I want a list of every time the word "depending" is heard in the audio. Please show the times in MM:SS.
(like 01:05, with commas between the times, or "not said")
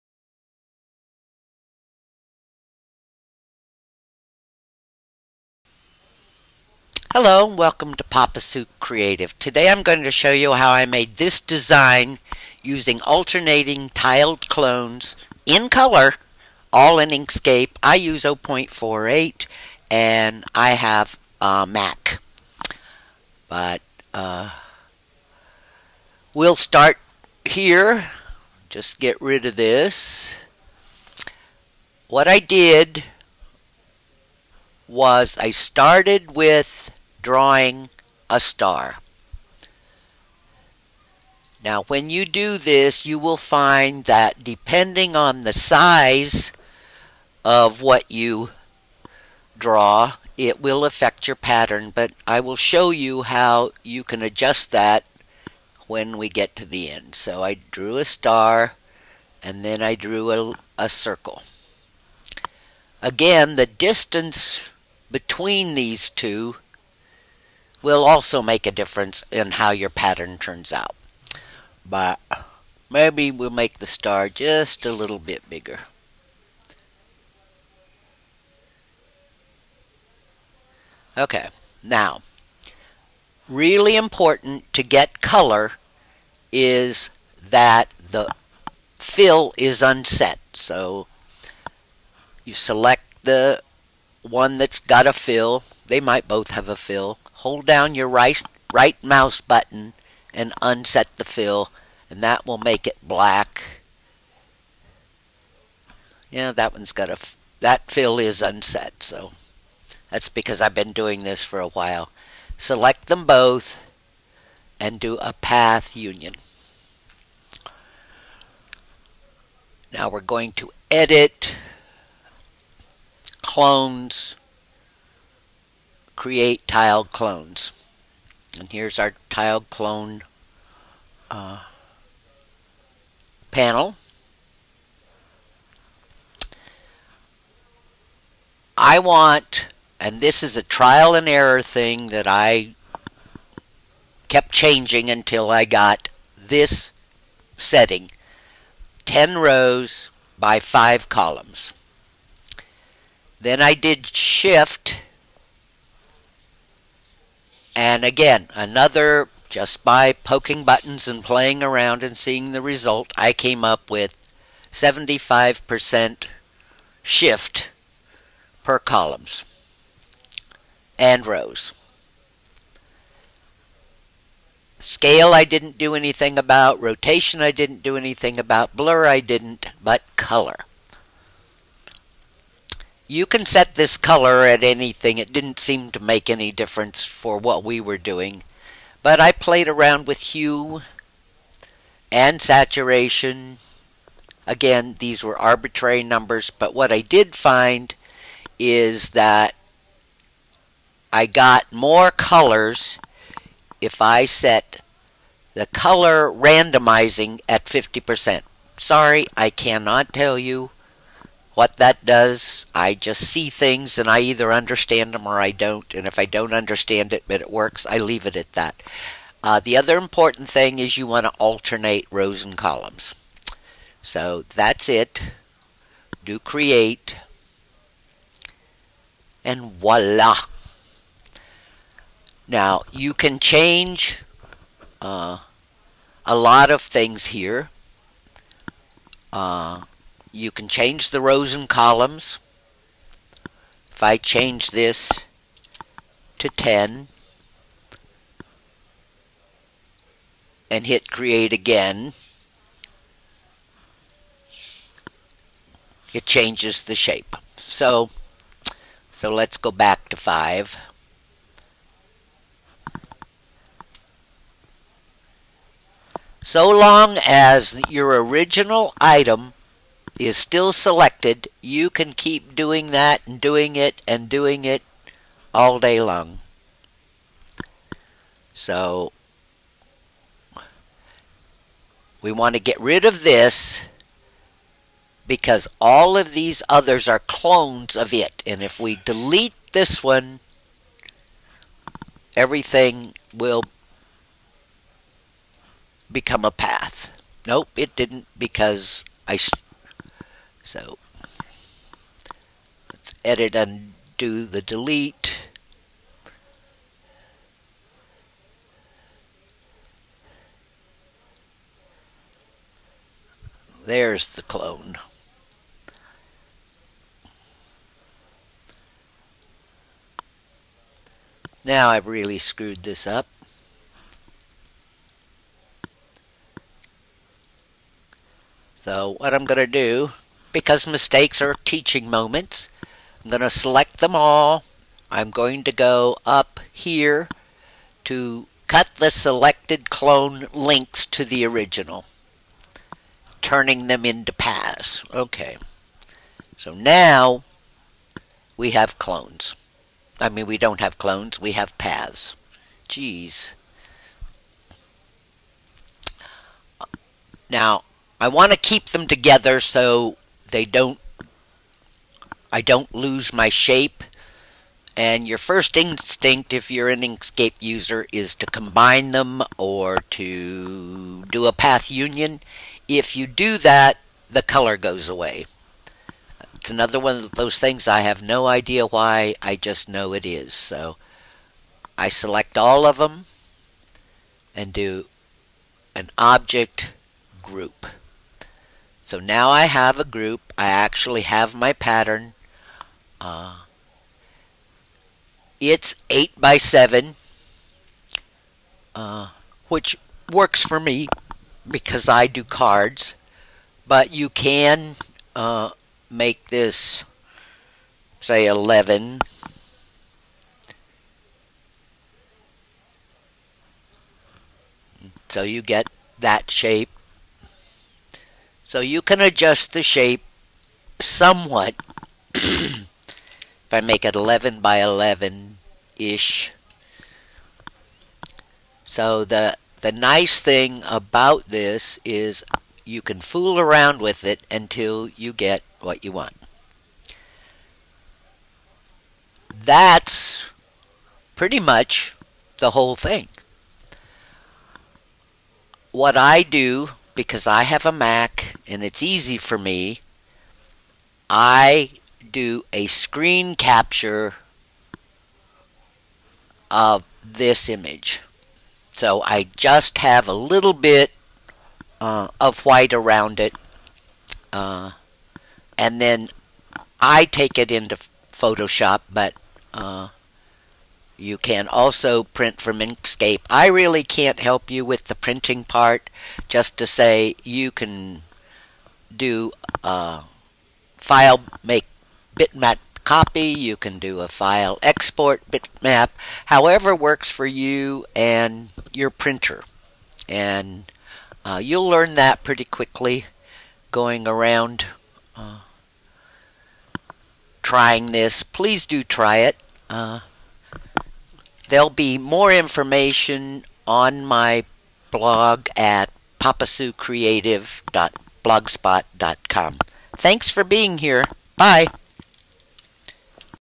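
00:44.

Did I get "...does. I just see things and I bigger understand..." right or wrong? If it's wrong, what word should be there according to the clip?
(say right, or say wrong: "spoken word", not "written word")
wrong: "either", not "bigger".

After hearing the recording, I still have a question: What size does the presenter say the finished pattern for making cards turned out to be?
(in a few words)
8 by 7.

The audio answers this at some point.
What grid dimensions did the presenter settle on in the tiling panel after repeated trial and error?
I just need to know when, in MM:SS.
02:29.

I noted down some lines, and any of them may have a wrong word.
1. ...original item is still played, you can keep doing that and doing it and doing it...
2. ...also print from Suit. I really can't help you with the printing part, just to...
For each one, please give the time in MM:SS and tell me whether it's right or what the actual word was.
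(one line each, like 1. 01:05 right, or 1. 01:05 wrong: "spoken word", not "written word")
1. 04:28 wrong: "selected", not "played"
2. 07:51 wrong: "Inkscape", not "Suit".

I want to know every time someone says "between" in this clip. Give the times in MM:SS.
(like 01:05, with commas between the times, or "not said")
01:05.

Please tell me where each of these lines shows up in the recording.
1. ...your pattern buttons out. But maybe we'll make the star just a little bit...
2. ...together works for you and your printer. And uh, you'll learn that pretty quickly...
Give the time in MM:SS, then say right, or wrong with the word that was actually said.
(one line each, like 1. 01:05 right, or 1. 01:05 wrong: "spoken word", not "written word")
1. 01:09 wrong: "turns", not "buttons"
2. 08:06 wrong: "however", not "together".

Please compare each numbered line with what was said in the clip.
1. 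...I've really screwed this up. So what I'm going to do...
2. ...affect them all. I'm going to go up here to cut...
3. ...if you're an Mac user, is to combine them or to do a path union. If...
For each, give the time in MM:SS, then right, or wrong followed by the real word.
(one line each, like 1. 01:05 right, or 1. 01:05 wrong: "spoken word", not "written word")
1. 05:21 right
2. 05:33 wrong: "select", not "affect"
3. 06:06 wrong: "Inkscape", not "Mac".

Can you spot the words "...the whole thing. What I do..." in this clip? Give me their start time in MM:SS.
07:22.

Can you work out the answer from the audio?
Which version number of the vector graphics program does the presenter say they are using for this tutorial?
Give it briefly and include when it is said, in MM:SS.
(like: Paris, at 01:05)
0.48, at 00:18.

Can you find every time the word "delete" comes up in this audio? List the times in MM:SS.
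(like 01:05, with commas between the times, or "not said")
04:49, 05:04.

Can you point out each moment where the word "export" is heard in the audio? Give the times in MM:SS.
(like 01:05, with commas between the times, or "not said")
08:04.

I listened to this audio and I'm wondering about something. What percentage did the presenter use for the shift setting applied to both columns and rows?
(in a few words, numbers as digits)
75%.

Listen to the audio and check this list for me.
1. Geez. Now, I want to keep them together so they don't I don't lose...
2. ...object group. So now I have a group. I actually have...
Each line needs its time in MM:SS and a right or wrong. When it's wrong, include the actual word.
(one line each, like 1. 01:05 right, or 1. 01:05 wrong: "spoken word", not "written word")
1. 05:52 right
2. 06:26 right.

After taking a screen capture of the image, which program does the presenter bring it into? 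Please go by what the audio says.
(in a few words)
Photoshop.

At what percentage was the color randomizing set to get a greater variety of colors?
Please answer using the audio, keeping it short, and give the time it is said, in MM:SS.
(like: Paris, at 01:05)
50%, at 03:27.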